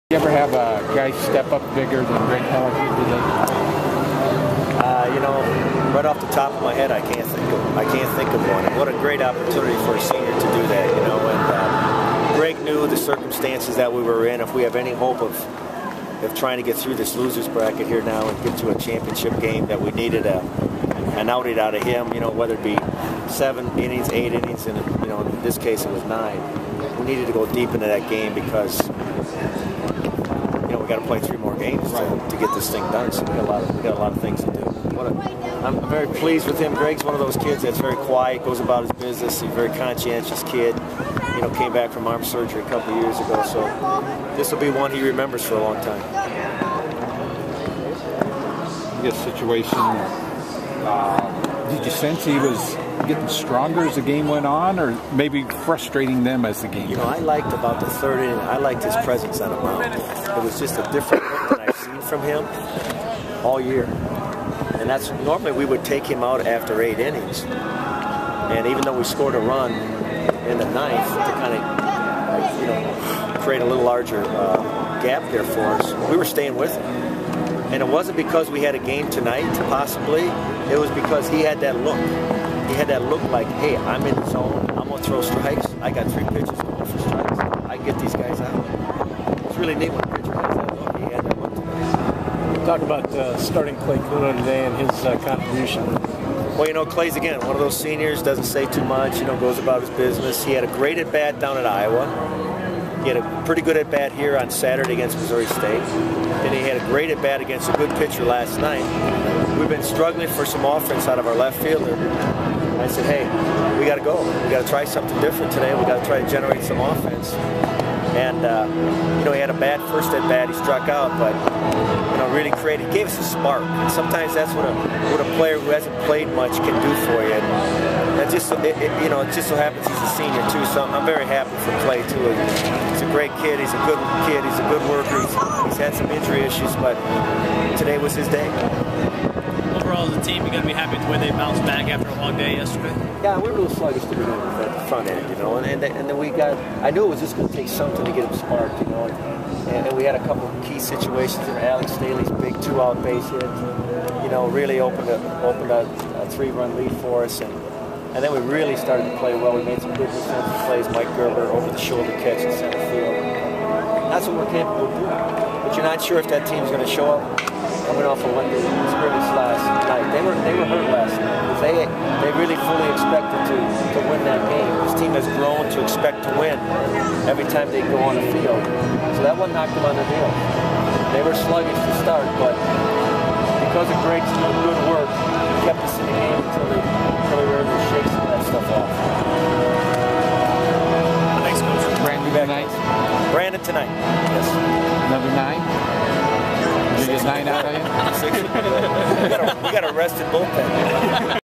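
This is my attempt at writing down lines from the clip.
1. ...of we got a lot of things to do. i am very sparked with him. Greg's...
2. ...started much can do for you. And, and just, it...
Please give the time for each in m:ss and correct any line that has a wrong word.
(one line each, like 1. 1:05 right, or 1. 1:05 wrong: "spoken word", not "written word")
1. 0:33 wrong: "pleased", not "sparked"
2. 2:06 wrong: "played", not "started".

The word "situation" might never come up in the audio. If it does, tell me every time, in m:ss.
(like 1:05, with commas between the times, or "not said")
0:49, 2:30.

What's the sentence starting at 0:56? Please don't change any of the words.
You know, I liked about the third inning.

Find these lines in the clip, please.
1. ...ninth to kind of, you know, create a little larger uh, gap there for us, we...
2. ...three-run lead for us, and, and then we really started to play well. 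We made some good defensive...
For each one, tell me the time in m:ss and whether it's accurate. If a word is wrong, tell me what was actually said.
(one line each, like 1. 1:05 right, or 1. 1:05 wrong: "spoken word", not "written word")
1. 1:10 right
2. 2:36 right.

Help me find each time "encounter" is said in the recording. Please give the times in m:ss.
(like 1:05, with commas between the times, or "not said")
not said.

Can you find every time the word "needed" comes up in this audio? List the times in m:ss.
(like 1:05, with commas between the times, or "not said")
0:19, 0:27.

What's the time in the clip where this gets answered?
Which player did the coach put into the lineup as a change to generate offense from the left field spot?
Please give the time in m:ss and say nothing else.
1:33.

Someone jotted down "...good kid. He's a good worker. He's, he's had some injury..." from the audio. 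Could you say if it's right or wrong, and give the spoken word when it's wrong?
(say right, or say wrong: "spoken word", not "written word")
right.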